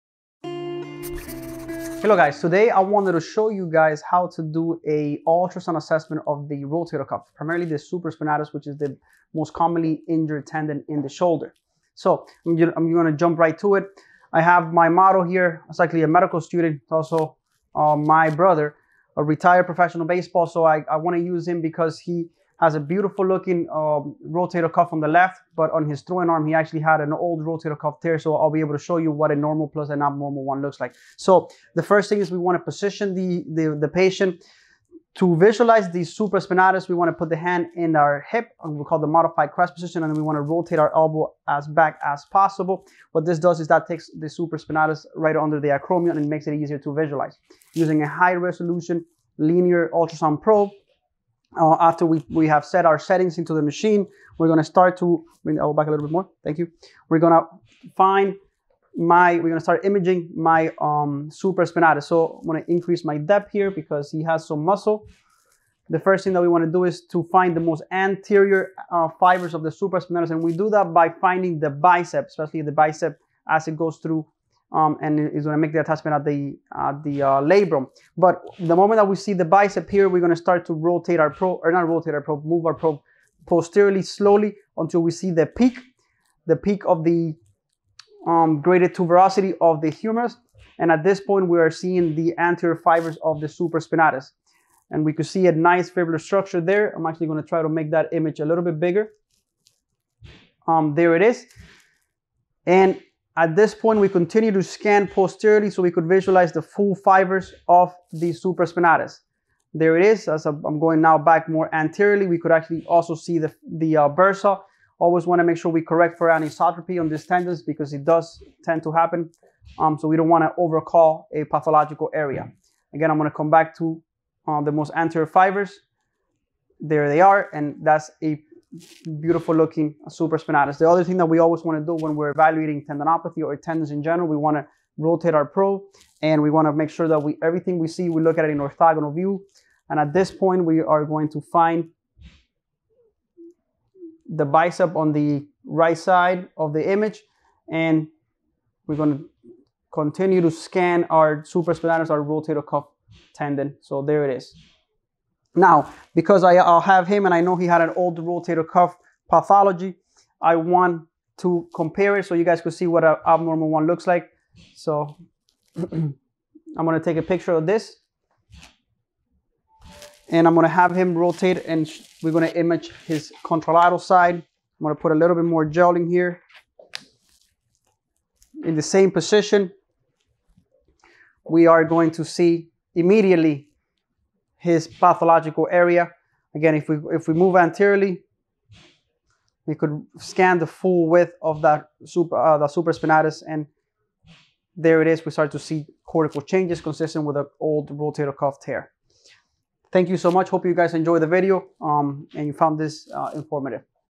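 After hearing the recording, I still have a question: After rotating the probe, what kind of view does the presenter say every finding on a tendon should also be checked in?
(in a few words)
orthogonal view.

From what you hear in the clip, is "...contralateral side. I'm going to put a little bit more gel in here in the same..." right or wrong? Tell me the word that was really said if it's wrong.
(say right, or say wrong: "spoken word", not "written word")
right.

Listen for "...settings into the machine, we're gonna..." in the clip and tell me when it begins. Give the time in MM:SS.
00:52.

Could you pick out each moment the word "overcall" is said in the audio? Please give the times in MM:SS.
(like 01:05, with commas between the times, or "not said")
02:00.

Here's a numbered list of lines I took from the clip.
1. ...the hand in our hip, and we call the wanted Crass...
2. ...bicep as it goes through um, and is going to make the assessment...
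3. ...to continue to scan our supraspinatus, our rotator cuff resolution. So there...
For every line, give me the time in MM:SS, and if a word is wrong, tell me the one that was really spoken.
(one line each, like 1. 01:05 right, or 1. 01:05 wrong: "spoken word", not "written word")
1. 00:37 wrong: "modified", not "wanted"
2. 01:12 wrong: "attachment", not "assessment"
3. 02:29 wrong: "tendon", not "resolution".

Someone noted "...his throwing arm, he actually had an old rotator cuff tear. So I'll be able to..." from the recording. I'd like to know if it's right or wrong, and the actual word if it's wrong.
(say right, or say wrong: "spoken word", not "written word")
right.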